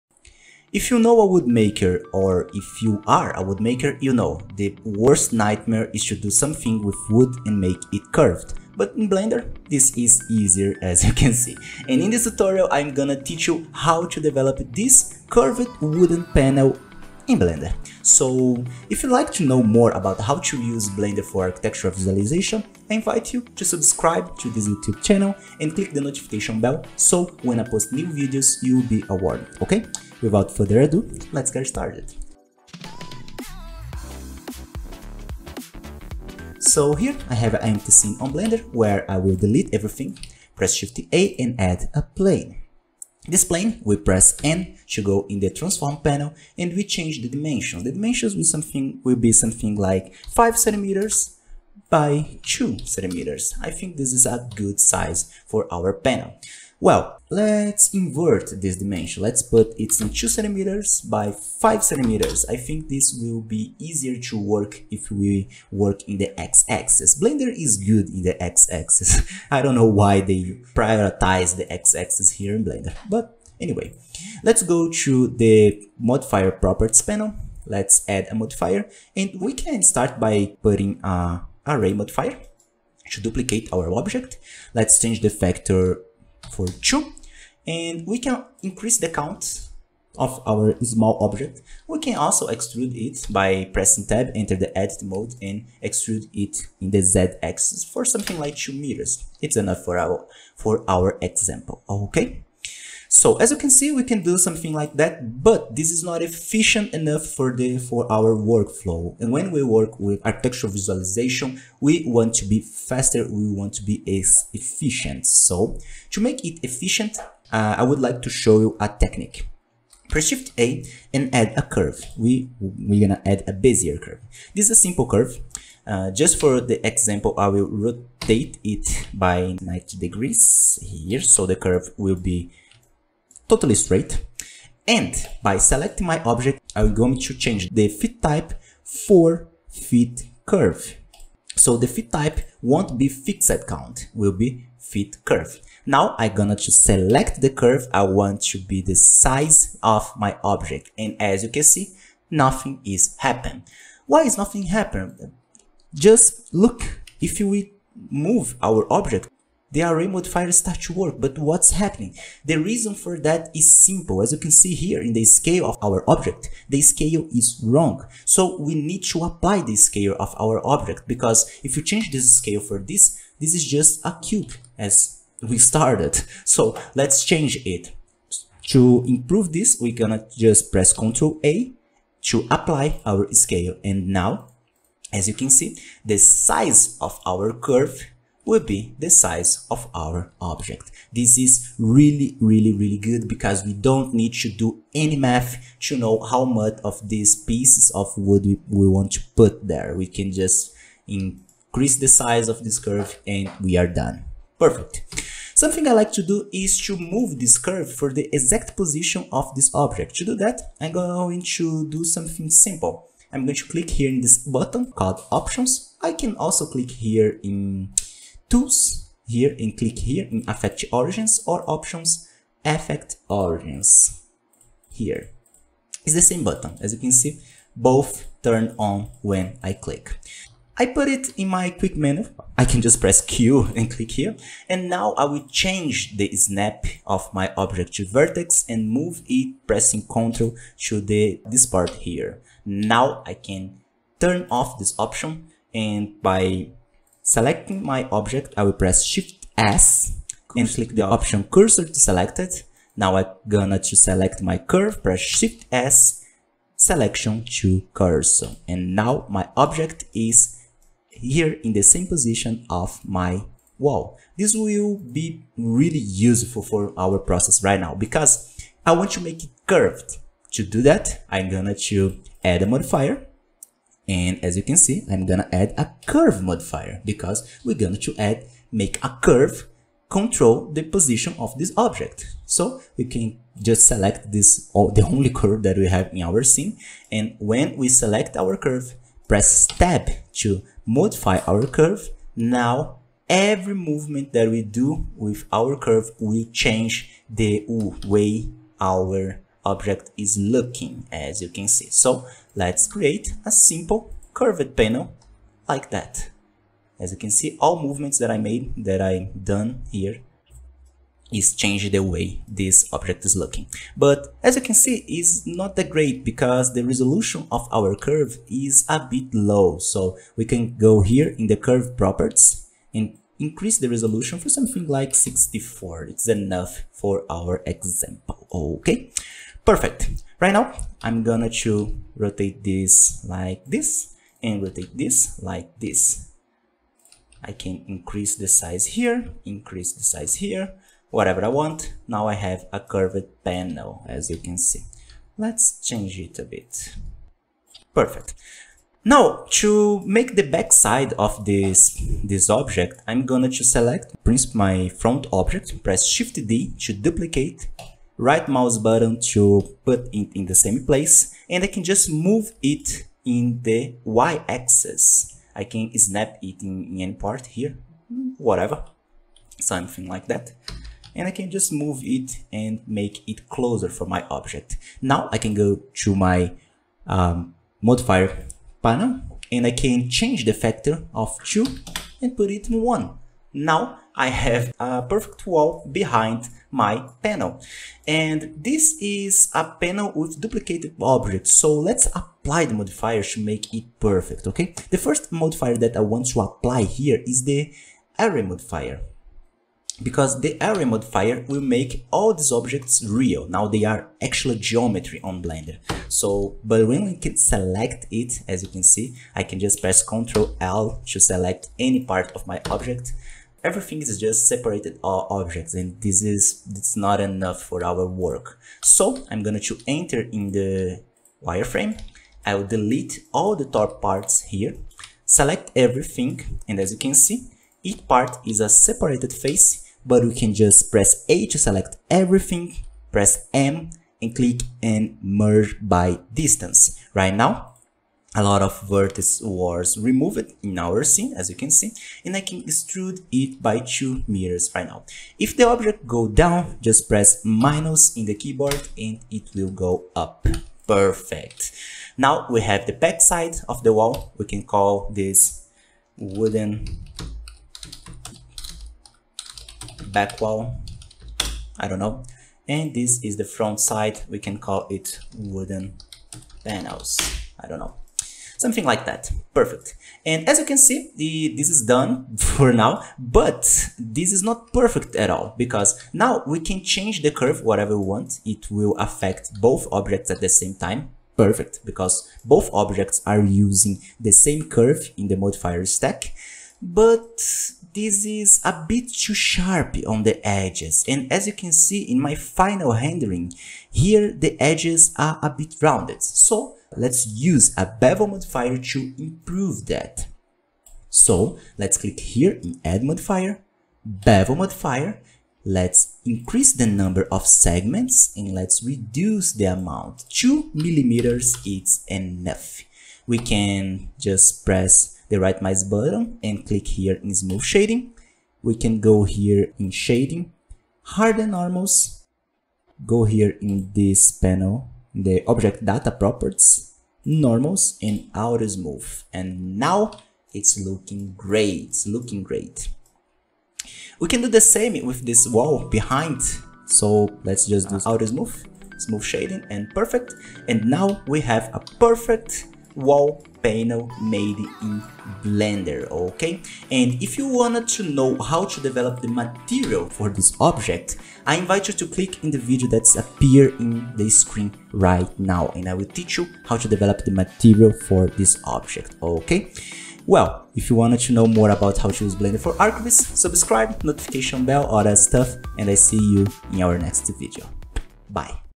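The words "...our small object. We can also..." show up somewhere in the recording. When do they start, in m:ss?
1:30.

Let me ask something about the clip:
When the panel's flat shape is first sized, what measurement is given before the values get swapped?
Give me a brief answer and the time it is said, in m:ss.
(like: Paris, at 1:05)
5 cm by 2 cm, at 0:50.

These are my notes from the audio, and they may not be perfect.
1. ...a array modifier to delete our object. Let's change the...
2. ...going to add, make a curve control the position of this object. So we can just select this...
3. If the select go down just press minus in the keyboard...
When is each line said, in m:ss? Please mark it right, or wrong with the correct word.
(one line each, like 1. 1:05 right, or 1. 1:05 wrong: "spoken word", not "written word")
1. 1:21 wrong: "duplicate", not "delete"
2. 4:37 right
3. 7:25 wrong: "object", not "select".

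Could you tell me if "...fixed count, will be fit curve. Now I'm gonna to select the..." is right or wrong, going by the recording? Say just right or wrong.
right.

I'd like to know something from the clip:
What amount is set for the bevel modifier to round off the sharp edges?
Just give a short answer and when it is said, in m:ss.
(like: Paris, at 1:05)
2 millimeters, at 8:30.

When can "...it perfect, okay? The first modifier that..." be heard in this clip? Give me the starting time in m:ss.
6:33.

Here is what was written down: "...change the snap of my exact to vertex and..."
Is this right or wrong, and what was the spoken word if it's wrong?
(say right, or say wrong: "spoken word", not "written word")
wrong: "object", not "exact".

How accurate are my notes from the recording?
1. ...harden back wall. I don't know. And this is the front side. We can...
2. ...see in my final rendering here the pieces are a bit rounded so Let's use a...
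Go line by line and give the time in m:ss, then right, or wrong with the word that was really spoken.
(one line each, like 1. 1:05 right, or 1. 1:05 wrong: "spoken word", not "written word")
1. 7:36 wrong: "wooden", not "harden"
2. 8:11 wrong: "edges", not "pieces".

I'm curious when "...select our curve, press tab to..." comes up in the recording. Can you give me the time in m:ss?
4:47.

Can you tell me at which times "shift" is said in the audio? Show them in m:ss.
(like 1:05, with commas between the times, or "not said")
0:40, 2:00, 4:09, 4:15, 5:56.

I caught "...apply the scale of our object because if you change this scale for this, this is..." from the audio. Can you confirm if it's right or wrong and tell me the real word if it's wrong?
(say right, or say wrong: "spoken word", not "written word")
right.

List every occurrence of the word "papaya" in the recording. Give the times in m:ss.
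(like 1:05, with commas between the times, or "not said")
not said.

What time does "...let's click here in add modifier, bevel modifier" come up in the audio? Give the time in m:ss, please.
8:21.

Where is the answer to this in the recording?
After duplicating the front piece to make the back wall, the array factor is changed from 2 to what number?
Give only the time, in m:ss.
6:22.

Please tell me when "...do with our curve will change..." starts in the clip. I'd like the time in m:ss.
4:54.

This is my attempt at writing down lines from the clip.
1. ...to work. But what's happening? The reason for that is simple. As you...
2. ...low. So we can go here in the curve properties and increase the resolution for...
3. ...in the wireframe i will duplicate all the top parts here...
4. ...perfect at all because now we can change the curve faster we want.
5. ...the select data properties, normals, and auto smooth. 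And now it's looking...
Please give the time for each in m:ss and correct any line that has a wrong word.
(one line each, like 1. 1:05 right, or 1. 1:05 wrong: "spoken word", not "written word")
1. 2:40 right
2. 5:19 right
3. 7:00 wrong: "delete", not "duplicate"
4. 7:54 wrong: "whatever", not "faster"
5. 8:45 wrong: "object", not "select".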